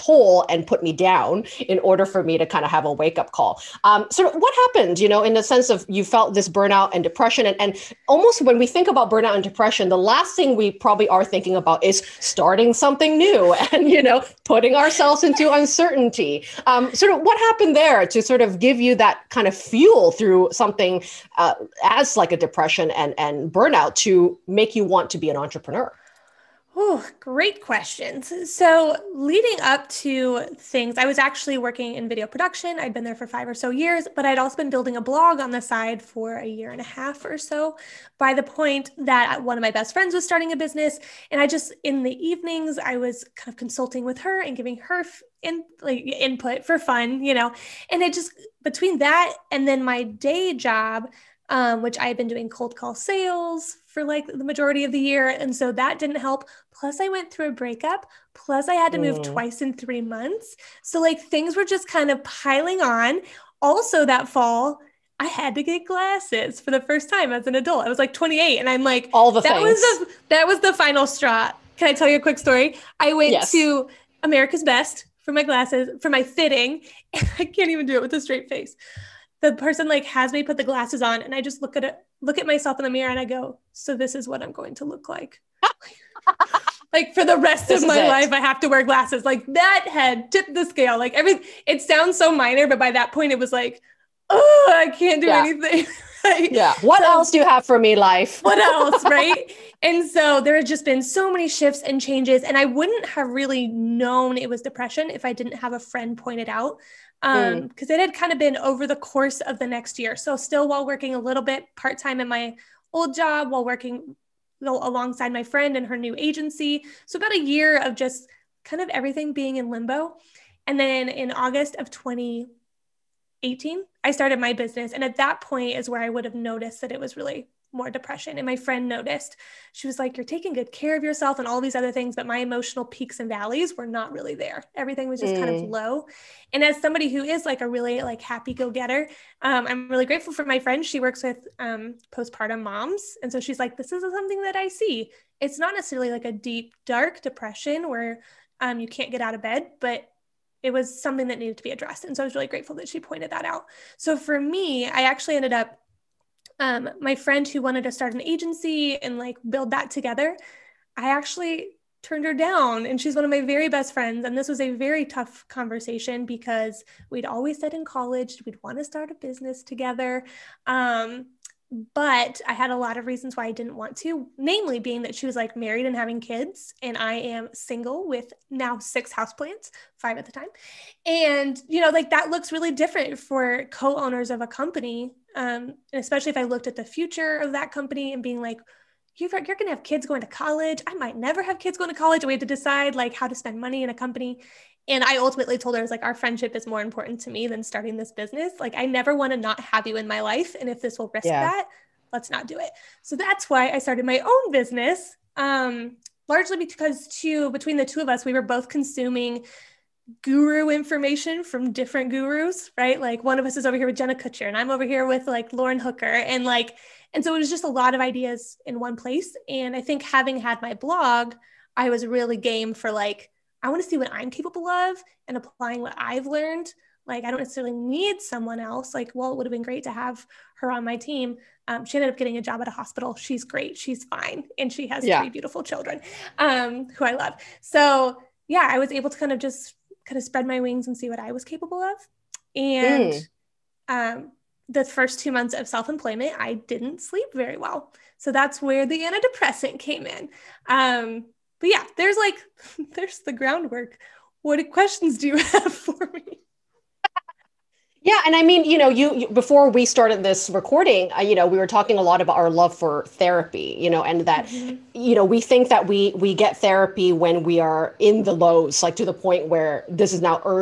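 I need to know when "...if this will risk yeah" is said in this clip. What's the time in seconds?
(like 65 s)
200 s.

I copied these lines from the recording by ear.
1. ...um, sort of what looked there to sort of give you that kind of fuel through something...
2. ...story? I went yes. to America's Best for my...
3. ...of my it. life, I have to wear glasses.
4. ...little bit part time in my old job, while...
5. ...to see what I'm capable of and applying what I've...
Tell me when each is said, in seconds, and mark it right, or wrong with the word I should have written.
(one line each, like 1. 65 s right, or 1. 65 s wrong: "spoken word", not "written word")
1. 16 s wrong: "happened", not "looked"
2. 72 s right
3. 87 s right
4. 111 s right
5. 223 s right.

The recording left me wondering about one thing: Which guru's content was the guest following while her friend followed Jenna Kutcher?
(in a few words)
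Lauren Hooker.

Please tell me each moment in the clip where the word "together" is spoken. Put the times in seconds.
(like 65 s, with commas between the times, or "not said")
159 s, 169 s.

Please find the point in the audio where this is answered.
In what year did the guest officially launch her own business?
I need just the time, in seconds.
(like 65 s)
121 s.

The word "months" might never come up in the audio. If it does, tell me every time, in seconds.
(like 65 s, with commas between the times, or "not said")
60 s, 245 s.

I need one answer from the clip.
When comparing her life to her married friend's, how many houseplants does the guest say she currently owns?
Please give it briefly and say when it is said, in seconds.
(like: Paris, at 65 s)
6, at 178 s.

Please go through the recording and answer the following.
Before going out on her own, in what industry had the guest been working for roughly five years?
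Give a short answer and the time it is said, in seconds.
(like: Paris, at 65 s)
video production, at 32 s.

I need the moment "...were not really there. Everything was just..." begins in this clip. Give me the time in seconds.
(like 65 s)
133 s.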